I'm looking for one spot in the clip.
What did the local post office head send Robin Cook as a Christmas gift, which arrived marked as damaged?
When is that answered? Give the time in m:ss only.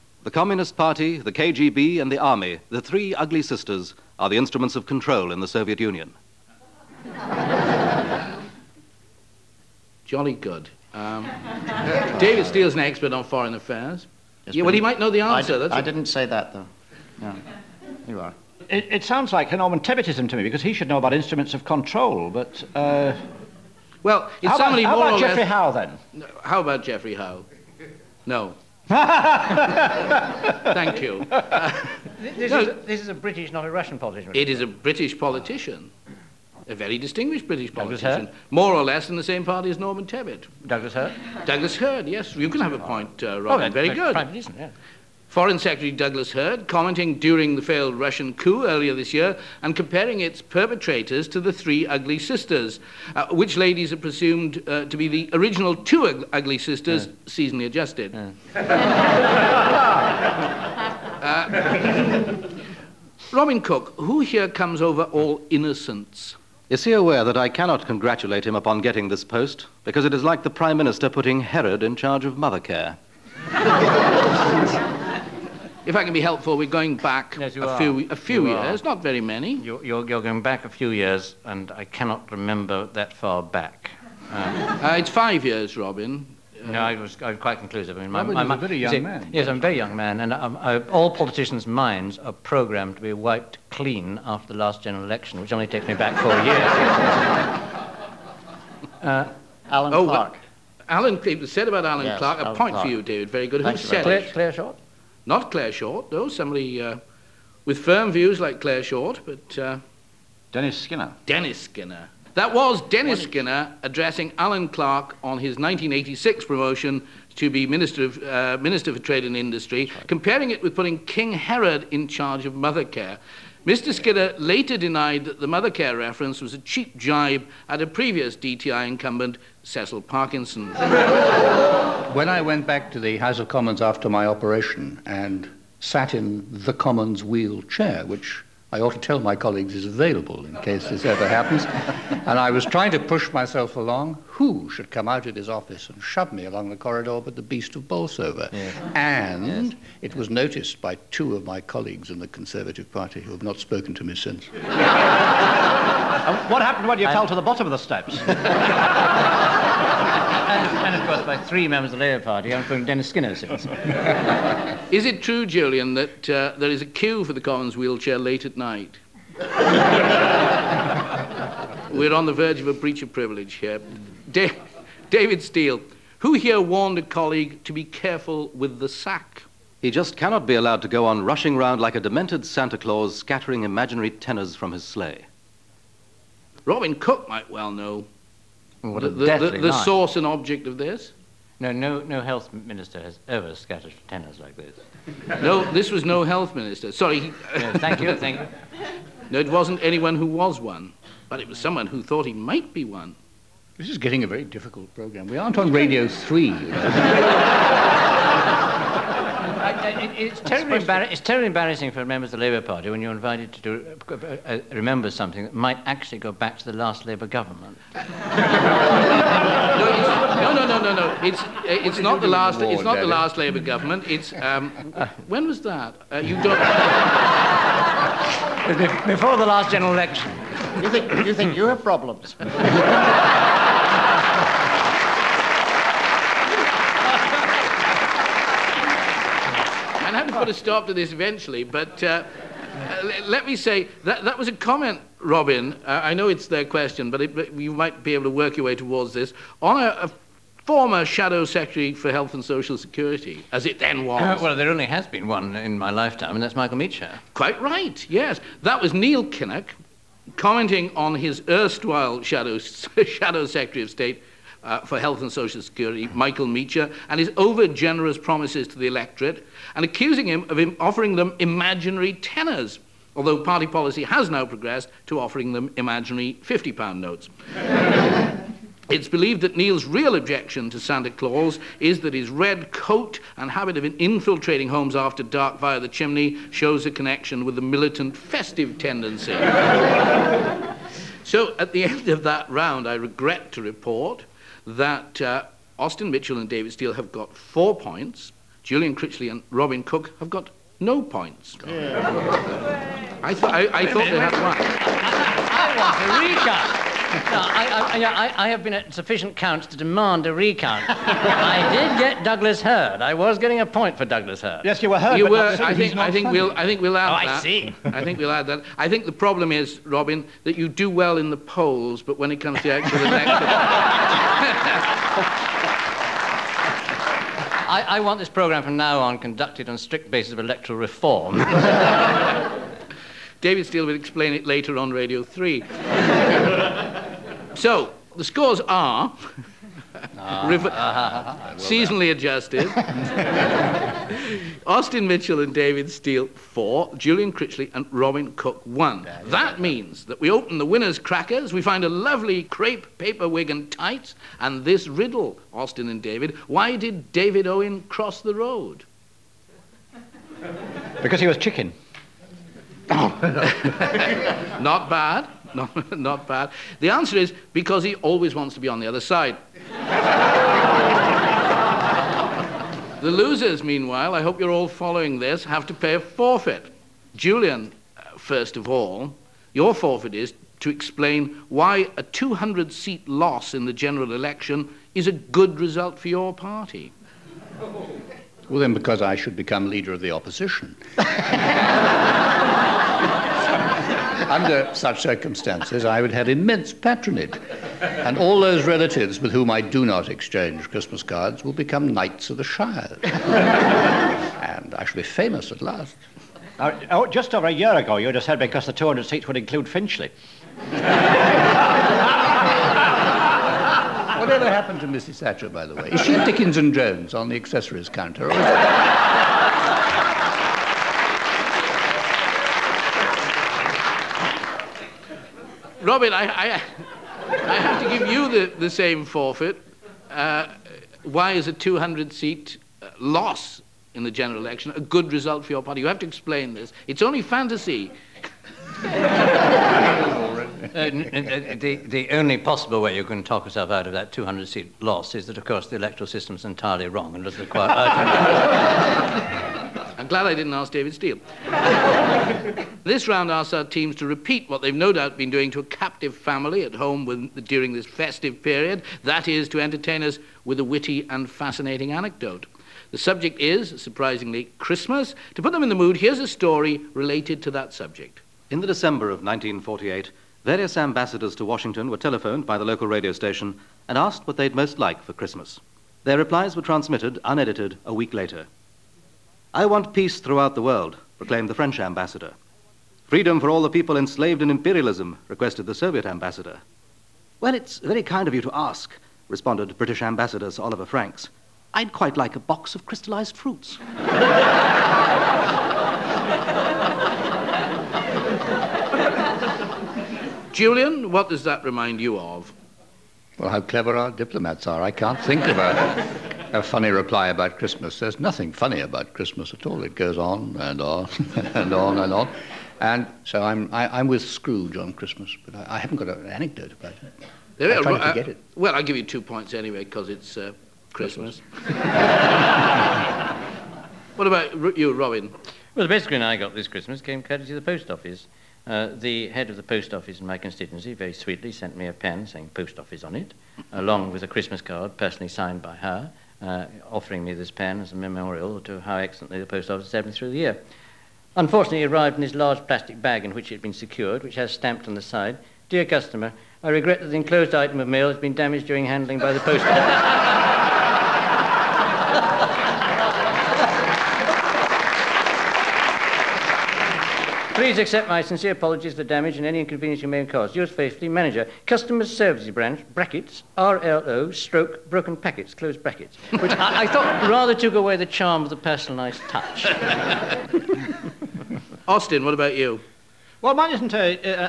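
8:51.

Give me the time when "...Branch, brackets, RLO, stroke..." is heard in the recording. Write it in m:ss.
9:22.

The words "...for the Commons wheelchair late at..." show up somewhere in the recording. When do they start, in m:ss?
2:47.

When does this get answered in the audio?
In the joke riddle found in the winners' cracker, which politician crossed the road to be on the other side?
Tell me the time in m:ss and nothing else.
5:57.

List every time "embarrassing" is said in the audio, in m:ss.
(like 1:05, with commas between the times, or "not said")
3:31.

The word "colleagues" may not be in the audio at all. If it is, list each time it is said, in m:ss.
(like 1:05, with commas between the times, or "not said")
2:19, 2:31, 2:57.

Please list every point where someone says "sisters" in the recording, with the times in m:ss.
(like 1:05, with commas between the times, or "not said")
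0:03, 0:52, 0:56.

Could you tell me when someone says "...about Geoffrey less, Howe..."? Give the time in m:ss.
0:25.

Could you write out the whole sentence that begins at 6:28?
Well, then, because I should become leader of the opposition.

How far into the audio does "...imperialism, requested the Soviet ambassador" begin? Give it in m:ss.
8:04.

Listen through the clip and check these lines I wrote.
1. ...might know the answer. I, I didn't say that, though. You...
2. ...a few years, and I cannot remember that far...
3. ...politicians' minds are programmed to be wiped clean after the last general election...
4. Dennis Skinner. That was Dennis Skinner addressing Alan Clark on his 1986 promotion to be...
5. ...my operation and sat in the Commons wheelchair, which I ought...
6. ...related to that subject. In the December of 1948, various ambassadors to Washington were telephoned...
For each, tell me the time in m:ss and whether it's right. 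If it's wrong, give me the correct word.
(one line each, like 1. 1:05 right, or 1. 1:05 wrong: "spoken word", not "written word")
1. 0:14 right
2. 1:20 right
3. 1:31 right
4. 1:51 right
5. 2:14 right
6. 7:46 right.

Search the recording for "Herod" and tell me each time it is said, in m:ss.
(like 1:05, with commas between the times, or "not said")
1:11, 2:01.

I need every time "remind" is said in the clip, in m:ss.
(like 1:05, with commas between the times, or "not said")
8:21.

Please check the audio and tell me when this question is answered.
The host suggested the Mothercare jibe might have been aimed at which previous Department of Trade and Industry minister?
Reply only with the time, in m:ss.
2:09.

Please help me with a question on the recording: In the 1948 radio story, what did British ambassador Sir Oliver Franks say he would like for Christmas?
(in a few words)
a box of crystallized fruits.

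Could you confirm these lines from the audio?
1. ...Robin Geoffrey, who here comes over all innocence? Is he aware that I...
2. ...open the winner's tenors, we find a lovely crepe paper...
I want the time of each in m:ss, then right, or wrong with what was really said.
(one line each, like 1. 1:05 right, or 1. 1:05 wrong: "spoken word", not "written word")
1. 1:03 wrong: "Cook", not "Geoffrey"
2. 5:50 wrong: "crackers", not "tenors".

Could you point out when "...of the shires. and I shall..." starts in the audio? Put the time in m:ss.
6:42.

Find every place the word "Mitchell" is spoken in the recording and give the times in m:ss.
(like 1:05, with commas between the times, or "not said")
4:56, 5:45.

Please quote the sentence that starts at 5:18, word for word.
I think the problem is, Robin, that you do well in the polls, but when it comes to actual election.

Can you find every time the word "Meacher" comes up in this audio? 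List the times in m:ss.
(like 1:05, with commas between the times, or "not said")
4:16, 4:26.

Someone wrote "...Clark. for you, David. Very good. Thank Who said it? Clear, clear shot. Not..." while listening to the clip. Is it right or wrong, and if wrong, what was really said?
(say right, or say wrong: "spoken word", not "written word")
right.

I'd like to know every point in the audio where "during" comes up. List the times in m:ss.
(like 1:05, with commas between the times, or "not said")
0:47, 7:37, 9:08.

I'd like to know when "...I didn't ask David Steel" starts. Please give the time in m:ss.
7:30.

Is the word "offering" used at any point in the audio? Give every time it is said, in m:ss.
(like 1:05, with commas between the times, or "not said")
4:30, 4:35, 8:56.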